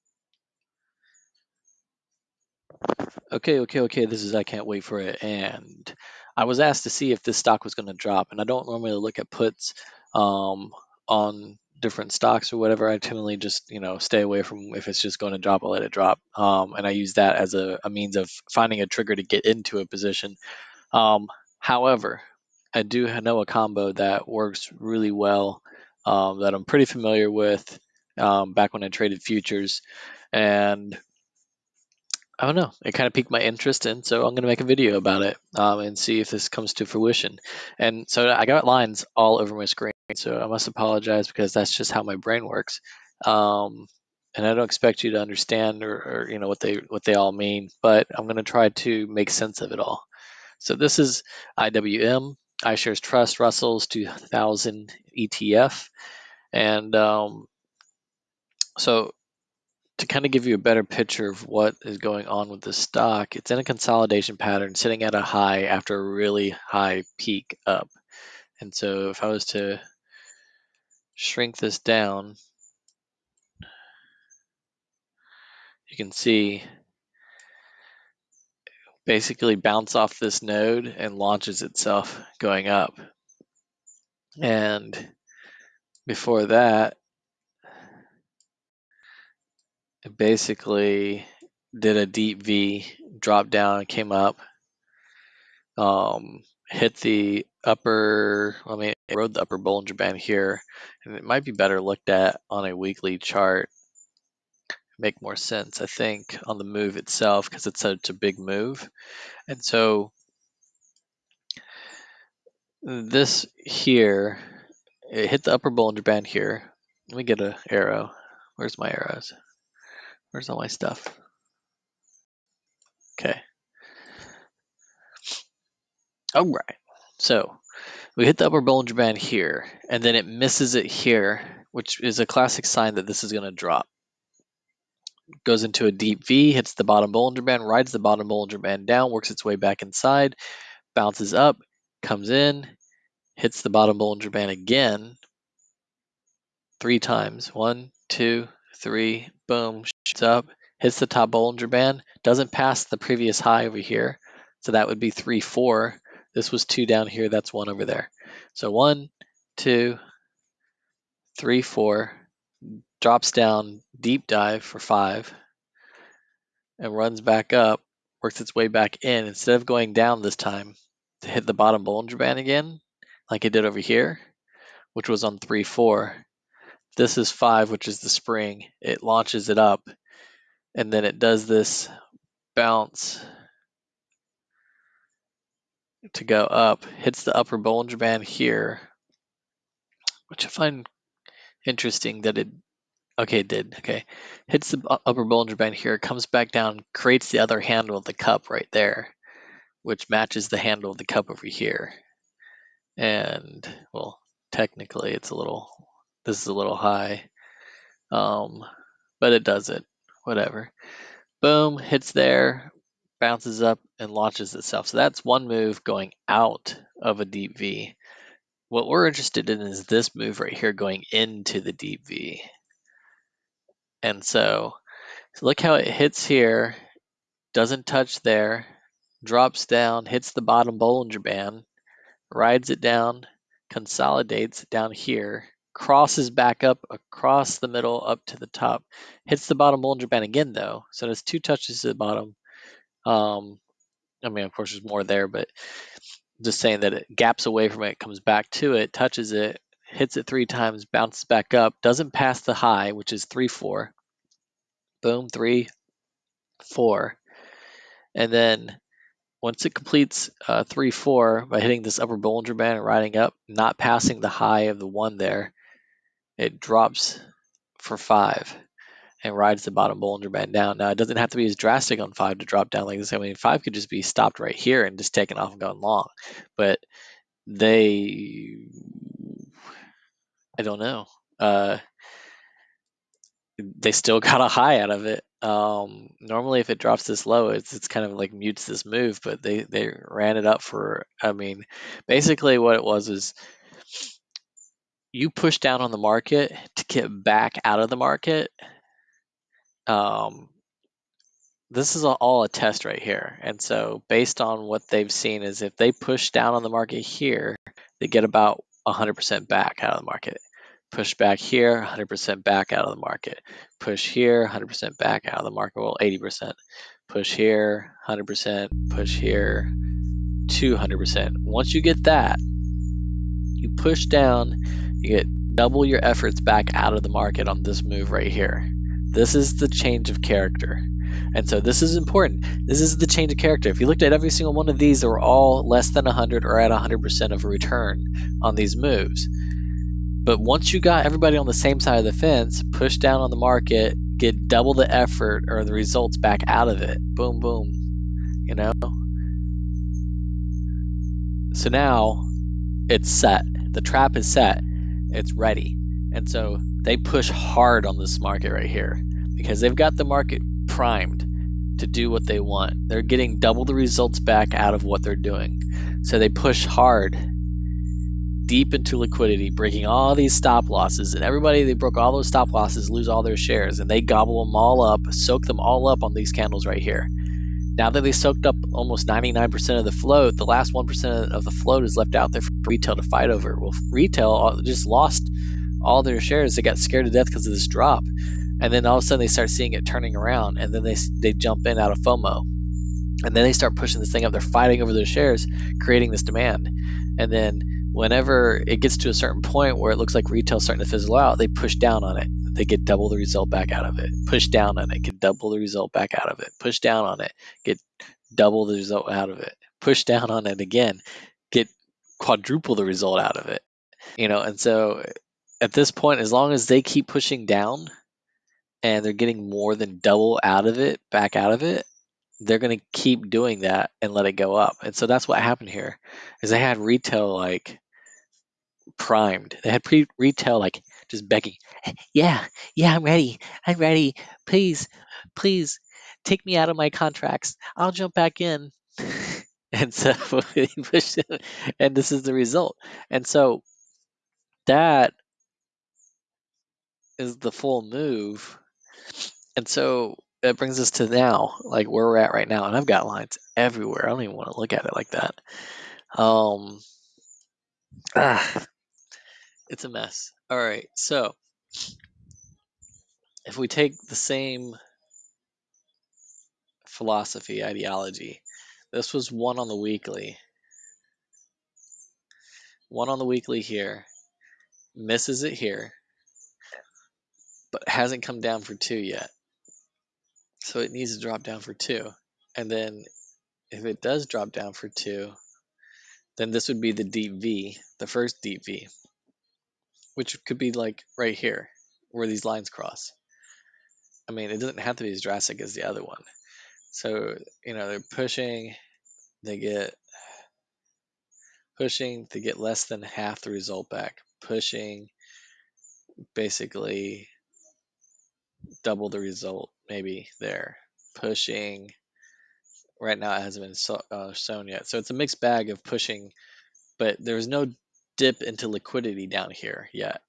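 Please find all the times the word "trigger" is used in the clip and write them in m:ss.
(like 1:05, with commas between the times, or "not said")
0:18.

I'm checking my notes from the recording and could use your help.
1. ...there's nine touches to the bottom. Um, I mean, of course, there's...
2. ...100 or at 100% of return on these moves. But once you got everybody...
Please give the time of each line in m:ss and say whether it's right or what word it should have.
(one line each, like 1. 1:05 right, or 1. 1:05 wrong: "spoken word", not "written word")
1. 4:01 wrong: "two", not "nine"
2. 5:36 right.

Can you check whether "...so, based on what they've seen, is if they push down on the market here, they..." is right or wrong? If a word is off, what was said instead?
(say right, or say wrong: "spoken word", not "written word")
right.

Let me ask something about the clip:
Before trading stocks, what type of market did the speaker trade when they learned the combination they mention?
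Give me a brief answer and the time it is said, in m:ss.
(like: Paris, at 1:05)
futures, at 0:29.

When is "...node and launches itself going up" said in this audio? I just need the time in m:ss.
1:20.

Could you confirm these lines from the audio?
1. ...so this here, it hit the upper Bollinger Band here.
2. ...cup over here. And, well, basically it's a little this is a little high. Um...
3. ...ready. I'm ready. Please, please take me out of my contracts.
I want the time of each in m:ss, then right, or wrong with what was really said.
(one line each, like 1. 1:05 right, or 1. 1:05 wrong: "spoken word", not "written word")
1. 1:49 right
2. 3:21 wrong: "technically", not "basically"
3. 7:13 right.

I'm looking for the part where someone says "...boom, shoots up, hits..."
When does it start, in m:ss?
2:29.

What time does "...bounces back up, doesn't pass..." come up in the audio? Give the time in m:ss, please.
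4:10.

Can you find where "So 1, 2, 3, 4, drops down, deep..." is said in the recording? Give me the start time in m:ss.
2:38.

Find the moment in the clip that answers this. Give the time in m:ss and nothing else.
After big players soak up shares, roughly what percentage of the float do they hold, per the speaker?
6:19.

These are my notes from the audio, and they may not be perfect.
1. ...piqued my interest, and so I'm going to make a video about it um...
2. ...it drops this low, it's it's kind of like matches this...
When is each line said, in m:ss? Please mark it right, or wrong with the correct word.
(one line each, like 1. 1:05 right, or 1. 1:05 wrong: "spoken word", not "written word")
1. 0:33 right
2. 4:46 wrong: "mutes", not "matches".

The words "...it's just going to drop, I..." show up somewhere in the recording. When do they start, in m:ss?
0:14.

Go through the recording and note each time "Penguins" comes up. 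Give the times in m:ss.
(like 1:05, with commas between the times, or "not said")
not said.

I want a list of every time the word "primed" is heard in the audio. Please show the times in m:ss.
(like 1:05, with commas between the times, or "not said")
6:00, 7:08.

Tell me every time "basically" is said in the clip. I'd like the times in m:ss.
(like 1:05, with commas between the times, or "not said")
1:19, 1:30, 4:52, 8:26.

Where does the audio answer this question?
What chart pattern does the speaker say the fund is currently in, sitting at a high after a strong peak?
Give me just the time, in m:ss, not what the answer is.
1:03.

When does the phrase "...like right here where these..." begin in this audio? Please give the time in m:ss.
8:10.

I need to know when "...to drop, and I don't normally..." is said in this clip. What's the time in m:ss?
0:07.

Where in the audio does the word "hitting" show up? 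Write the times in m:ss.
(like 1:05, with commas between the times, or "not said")
4:21.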